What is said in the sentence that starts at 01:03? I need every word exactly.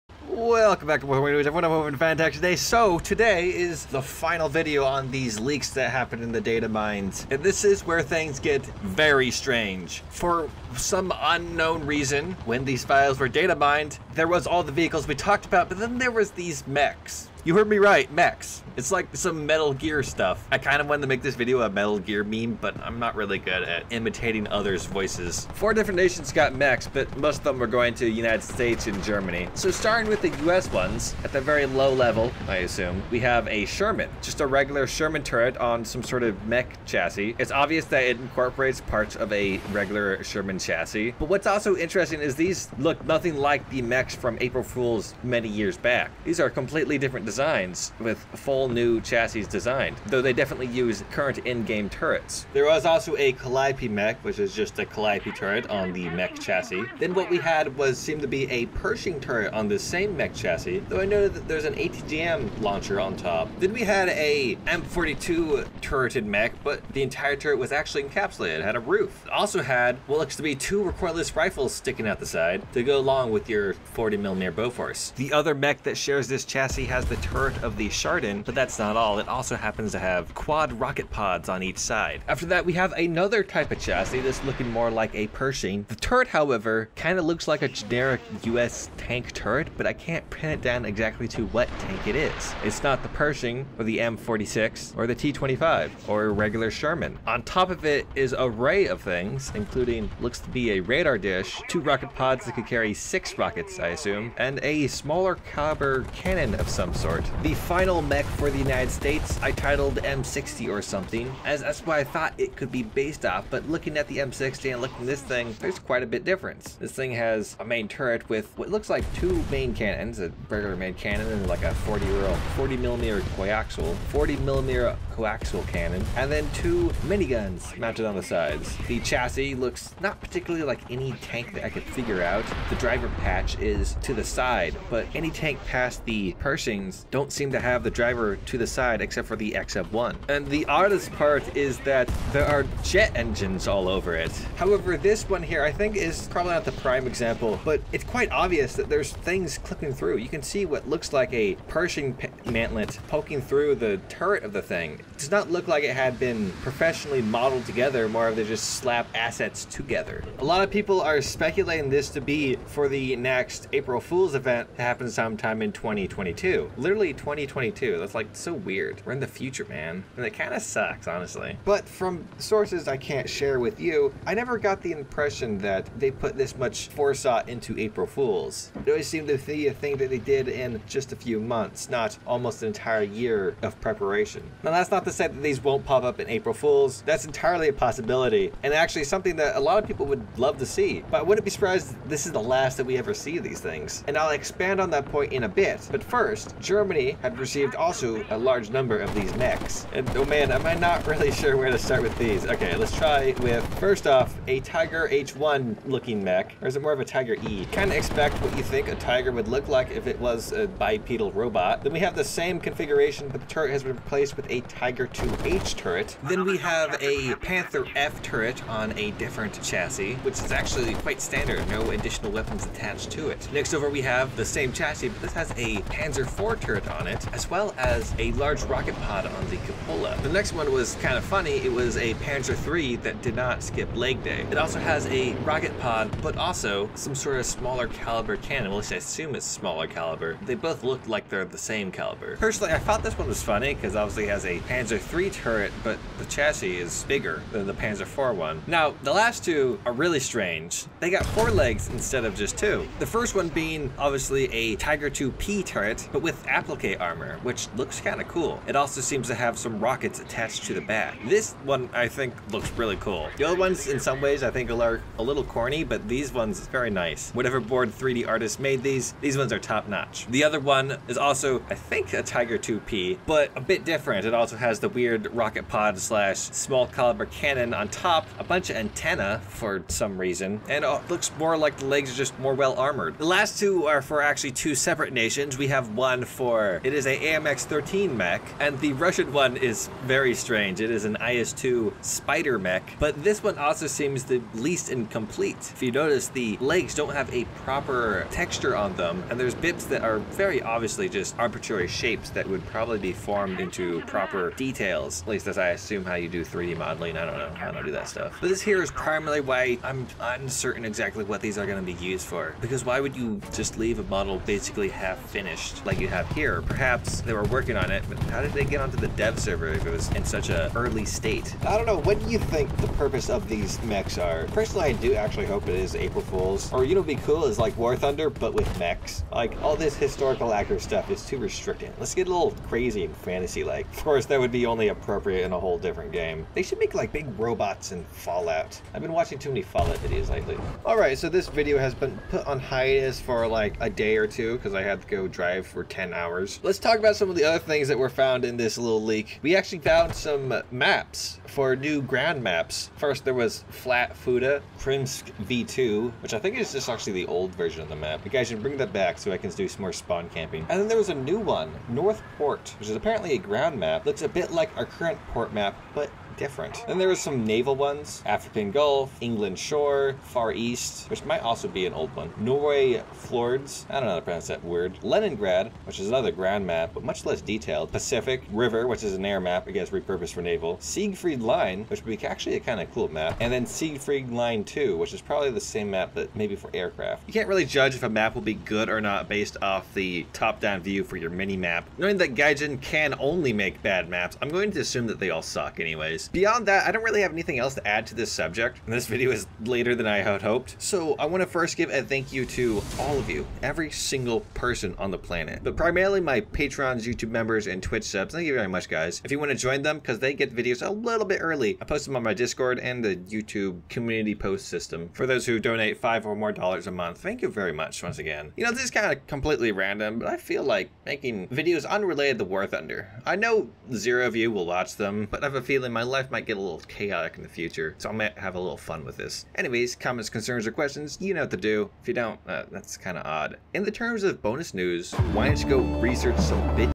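Then we had a M42 turreted mech, but the entire turret was actually encapsulated, had a roof.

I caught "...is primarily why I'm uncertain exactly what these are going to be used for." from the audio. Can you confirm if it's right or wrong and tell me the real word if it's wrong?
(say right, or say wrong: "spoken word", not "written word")
right.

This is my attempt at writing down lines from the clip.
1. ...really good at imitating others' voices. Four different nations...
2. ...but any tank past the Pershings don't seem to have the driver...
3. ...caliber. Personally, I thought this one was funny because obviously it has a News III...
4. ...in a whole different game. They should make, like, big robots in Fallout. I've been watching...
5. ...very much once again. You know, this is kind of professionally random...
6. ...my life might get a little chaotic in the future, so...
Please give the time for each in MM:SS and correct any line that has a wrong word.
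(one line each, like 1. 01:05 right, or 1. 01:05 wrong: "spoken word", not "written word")
1. 00:23 right
2. 02:14 right
3. 04:02 wrong: "Panzer", not "News"
4. 05:35 right
5. 06:57 wrong: "completely", not "professionally"
6. 07:05 right.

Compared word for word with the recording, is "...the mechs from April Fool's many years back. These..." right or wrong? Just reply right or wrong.
right.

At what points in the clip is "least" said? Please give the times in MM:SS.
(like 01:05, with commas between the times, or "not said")
03:58, 04:54, 05:05.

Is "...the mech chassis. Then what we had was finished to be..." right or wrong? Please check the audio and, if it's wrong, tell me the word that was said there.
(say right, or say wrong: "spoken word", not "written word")
wrong: "seemed", not "finished".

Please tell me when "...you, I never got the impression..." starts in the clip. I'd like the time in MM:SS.
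02:53.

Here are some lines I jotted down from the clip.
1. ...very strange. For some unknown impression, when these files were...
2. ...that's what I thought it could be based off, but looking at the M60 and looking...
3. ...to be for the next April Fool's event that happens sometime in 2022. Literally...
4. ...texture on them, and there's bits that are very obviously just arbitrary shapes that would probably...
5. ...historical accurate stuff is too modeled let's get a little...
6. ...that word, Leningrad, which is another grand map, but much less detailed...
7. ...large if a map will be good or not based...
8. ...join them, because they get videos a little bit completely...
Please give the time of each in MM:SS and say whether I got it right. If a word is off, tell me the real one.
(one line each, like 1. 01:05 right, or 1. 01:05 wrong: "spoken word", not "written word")
1. 00:08 wrong: "reason", not "impression"
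2. 01:51 right
3. 02:42 right
4. 04:58 right
5. 05:29 wrong: "restricted", not "modeled"
6. 06:14 right
7. 06:27 wrong: "judge", not "large"
8. 06:49 wrong: "early", not "completely".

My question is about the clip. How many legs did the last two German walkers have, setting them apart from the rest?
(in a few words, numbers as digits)
4.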